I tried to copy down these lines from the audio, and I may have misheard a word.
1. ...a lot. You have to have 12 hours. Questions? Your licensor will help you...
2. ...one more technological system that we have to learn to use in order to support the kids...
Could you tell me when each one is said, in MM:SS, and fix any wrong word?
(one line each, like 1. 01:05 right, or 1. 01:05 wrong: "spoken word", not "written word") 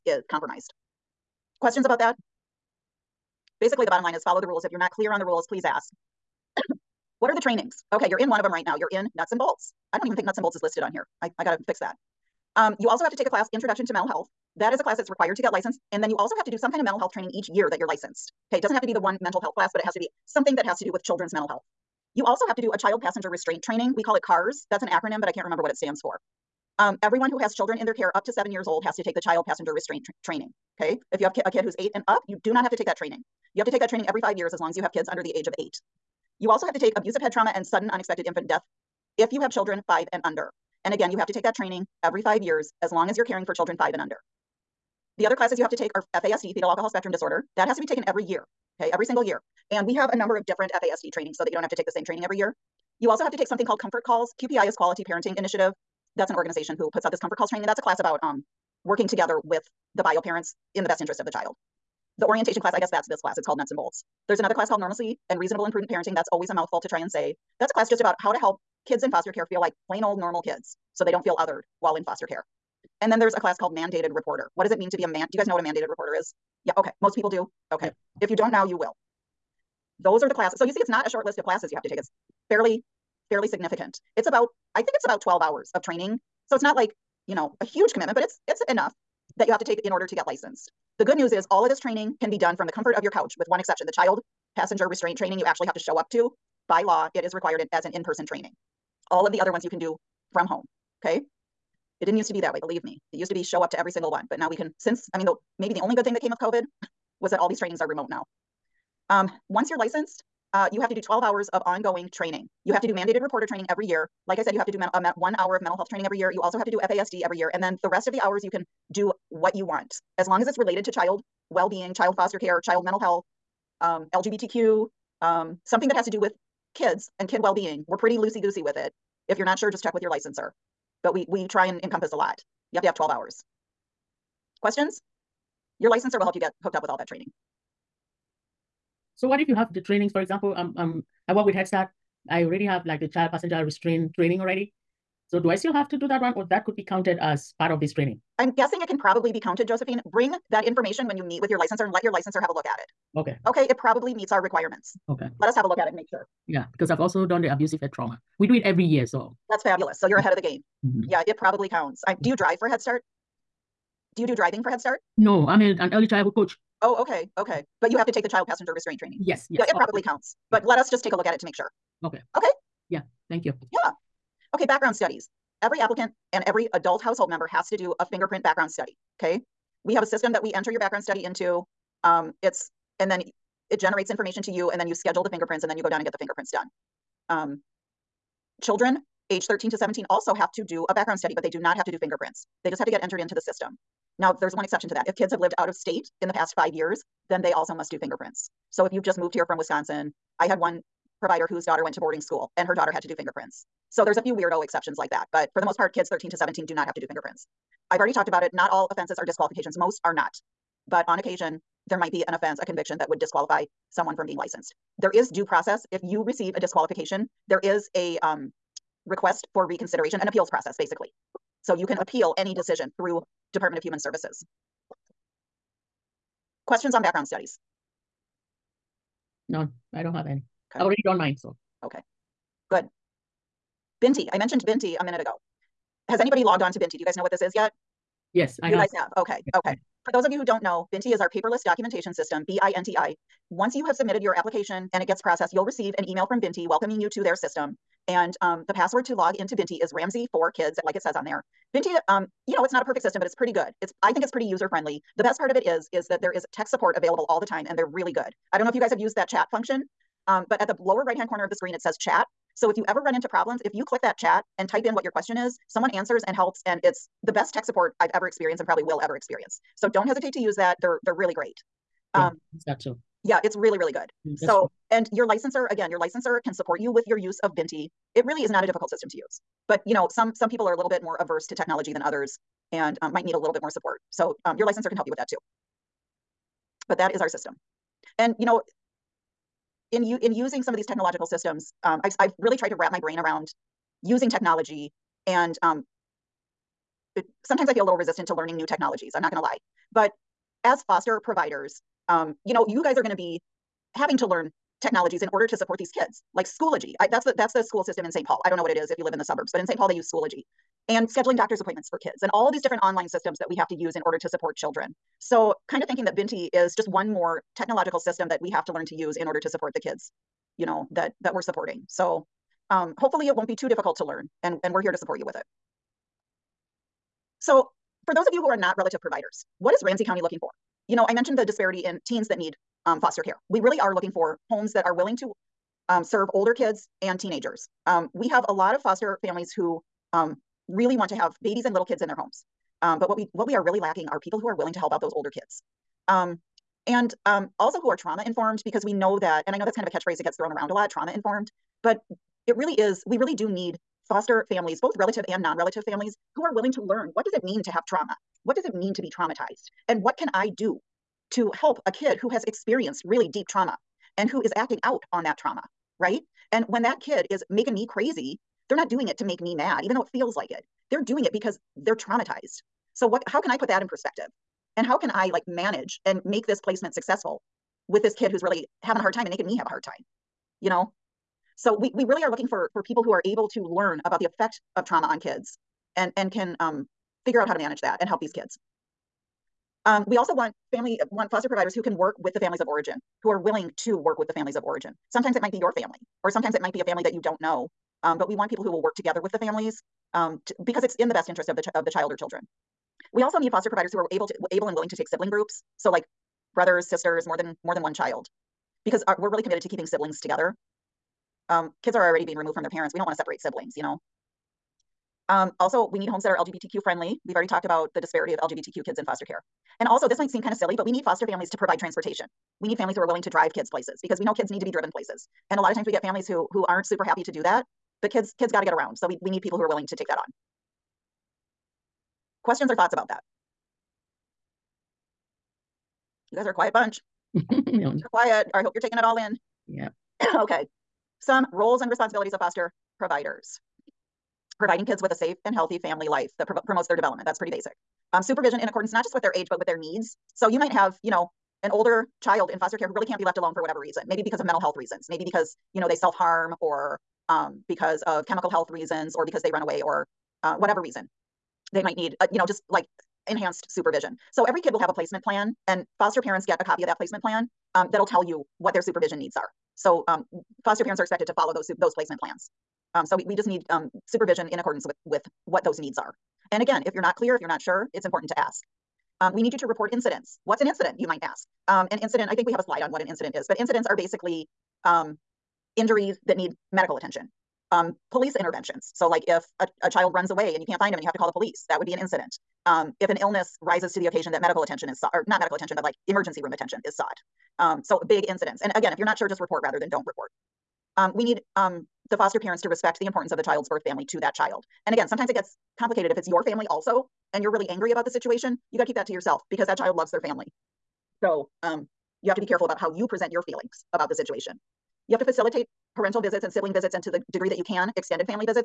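1. 02:12 right
2. 05:16 right.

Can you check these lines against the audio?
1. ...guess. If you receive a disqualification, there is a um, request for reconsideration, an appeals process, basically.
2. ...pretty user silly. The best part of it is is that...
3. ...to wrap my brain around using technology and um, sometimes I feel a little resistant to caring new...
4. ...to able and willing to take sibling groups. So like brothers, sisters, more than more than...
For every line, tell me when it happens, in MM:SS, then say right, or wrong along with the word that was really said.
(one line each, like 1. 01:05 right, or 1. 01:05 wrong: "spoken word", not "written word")
1. 03:35 wrong: "process", not "guess"
2. 04:14 wrong: "friendly", not "silly"
3. 04:52 wrong: "learning", not "caring"
4. 06:44 right.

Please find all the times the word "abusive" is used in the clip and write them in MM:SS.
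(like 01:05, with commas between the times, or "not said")
00:36, 02:37.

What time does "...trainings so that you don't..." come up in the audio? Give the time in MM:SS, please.
00:51.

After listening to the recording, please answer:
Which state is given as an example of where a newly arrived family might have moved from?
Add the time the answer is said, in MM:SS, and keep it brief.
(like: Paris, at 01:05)
Wisconsin, at 03:19.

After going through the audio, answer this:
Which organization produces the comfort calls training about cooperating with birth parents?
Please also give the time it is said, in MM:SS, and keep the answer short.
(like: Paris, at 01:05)
Quality Parenting Initiative, at 00:54.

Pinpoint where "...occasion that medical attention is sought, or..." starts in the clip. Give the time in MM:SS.
08:14.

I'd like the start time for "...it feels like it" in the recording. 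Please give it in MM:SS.
06:10.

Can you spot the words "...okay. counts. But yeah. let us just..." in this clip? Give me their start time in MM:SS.
02:49.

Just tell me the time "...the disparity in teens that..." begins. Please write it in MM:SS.
05:31.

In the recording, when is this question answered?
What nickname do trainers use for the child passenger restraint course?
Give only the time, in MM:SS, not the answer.
00:24.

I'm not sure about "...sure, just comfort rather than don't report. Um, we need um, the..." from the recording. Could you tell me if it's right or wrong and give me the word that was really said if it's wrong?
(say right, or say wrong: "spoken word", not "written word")
wrong: "report", not "comfort".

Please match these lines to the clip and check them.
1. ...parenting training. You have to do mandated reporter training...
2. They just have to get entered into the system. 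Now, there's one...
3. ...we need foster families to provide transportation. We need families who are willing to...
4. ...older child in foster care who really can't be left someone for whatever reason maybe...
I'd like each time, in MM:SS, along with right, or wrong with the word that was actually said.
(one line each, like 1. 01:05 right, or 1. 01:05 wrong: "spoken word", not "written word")
1. 01:51 wrong: "ongoing", not "parenting"
2. 03:12 right
3. 07:00 right
4. 07:31 wrong: "alone", not "someone".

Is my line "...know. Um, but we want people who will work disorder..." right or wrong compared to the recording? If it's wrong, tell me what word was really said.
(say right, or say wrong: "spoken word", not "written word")
wrong: "together", not "disorder".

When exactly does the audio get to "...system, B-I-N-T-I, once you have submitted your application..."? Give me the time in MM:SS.
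04:02.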